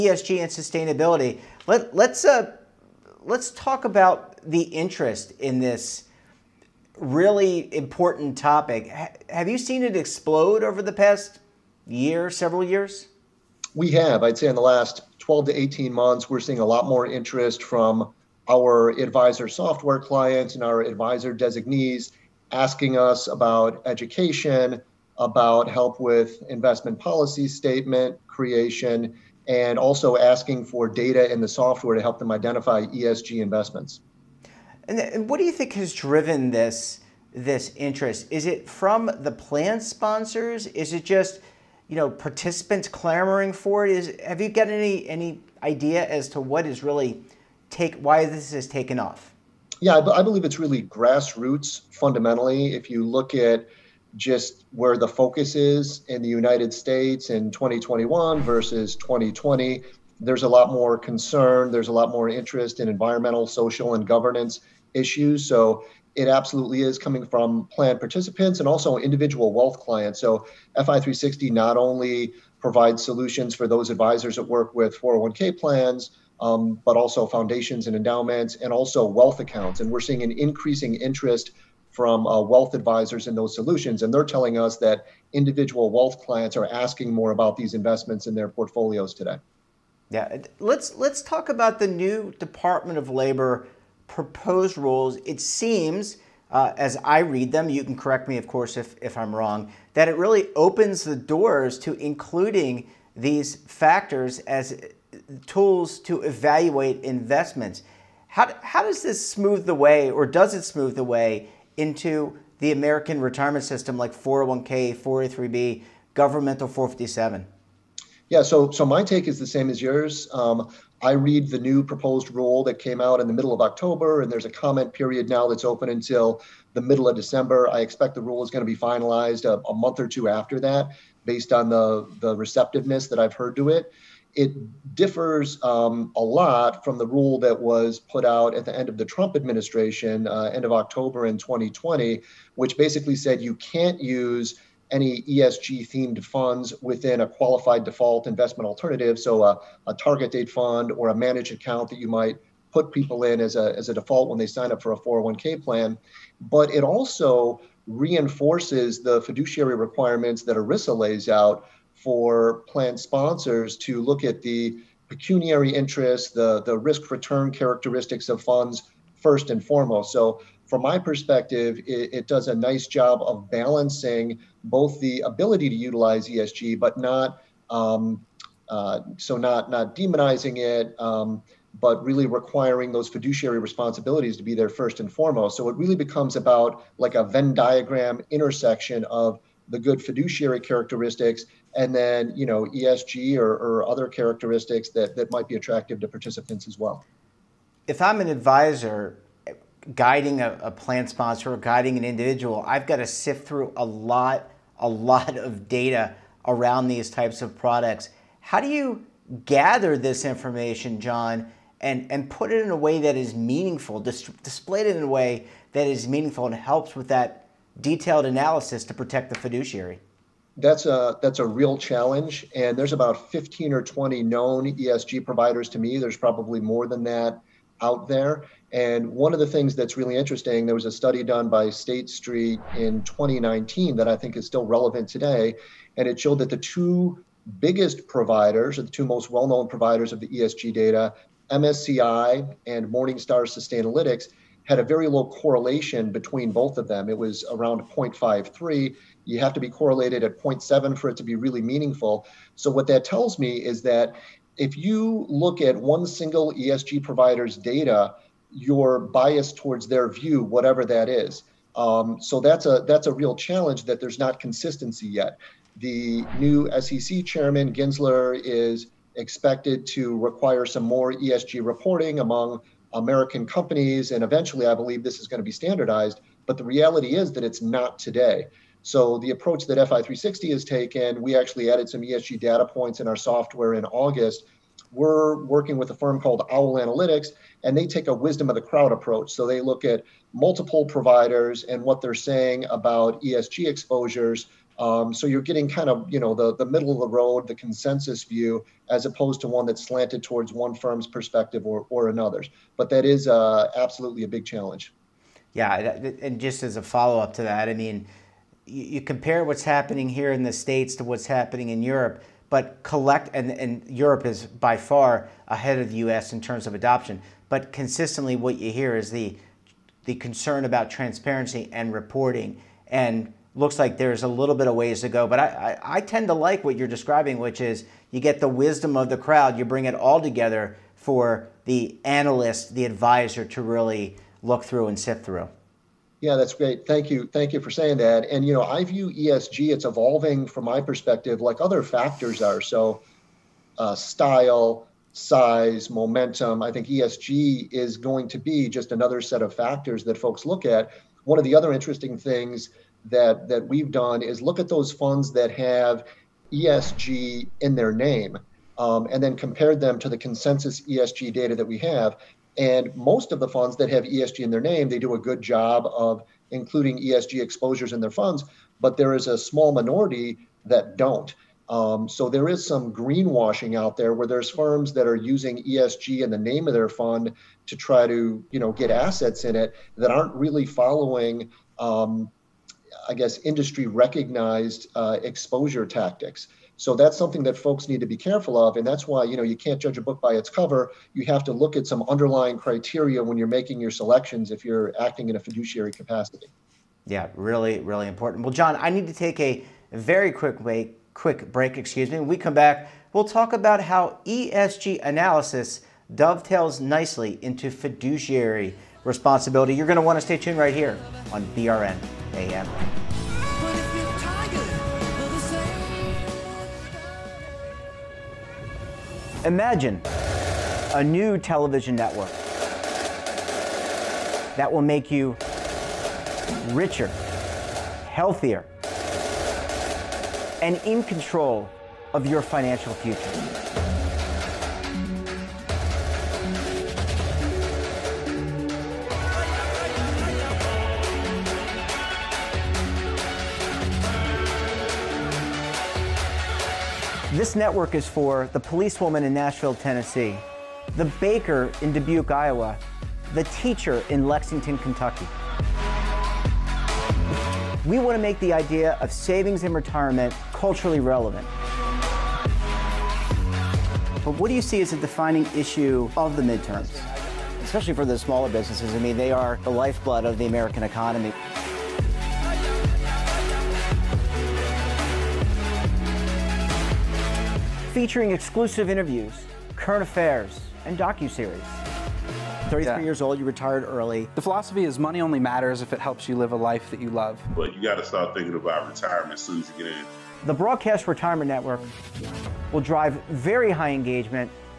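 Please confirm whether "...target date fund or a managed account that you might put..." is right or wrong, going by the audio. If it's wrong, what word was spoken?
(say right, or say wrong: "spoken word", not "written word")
right.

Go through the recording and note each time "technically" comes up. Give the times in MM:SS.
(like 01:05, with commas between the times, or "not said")
not said.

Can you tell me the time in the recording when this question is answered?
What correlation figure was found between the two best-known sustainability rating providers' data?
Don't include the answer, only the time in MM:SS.
04:07.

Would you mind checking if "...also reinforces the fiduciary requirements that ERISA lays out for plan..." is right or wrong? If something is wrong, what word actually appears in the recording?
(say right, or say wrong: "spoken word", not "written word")
right.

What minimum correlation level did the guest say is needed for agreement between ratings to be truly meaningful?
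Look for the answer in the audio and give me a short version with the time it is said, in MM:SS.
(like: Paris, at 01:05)
0.7, at 04:10.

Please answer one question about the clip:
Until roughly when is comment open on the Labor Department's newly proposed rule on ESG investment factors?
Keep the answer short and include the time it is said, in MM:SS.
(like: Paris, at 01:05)
middle of December, at 02:06.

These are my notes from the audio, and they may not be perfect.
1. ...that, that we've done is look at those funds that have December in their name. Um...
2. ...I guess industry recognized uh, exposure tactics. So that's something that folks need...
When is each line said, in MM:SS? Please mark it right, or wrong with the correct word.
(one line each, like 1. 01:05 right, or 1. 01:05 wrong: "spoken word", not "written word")
1. 05:53 wrong: "ESG", not "December"
2. 06:23 right.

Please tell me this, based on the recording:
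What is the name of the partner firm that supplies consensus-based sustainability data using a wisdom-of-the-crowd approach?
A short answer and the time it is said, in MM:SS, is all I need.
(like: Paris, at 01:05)
Owl Analytics, at 04:46.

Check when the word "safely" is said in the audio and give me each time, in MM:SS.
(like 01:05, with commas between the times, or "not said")
not said.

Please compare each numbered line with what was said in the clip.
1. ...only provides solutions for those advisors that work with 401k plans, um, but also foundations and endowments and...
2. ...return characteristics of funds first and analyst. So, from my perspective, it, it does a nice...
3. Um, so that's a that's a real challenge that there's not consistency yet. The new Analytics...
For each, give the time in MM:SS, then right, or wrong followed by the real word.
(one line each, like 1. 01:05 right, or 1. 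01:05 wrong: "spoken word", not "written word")
1. 01:11 right
2. 02:47 wrong: "foremost", not "analyst"
3. 04:21 wrong: "SEC", not "Analytics".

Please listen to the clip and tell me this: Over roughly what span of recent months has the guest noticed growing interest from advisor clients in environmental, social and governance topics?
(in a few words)
12 to 18 months.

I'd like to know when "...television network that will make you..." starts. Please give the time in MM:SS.
07:01.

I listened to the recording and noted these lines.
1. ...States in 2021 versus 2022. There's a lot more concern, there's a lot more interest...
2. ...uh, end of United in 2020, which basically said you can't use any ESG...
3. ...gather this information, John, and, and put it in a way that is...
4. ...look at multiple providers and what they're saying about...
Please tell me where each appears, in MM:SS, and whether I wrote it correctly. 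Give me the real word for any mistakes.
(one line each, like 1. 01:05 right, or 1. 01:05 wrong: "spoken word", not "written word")
1. 00:56 wrong: "2020", not "2022"
2. 02:20 wrong: "October", not "United"
3. 03:29 right
4. 04:49 right.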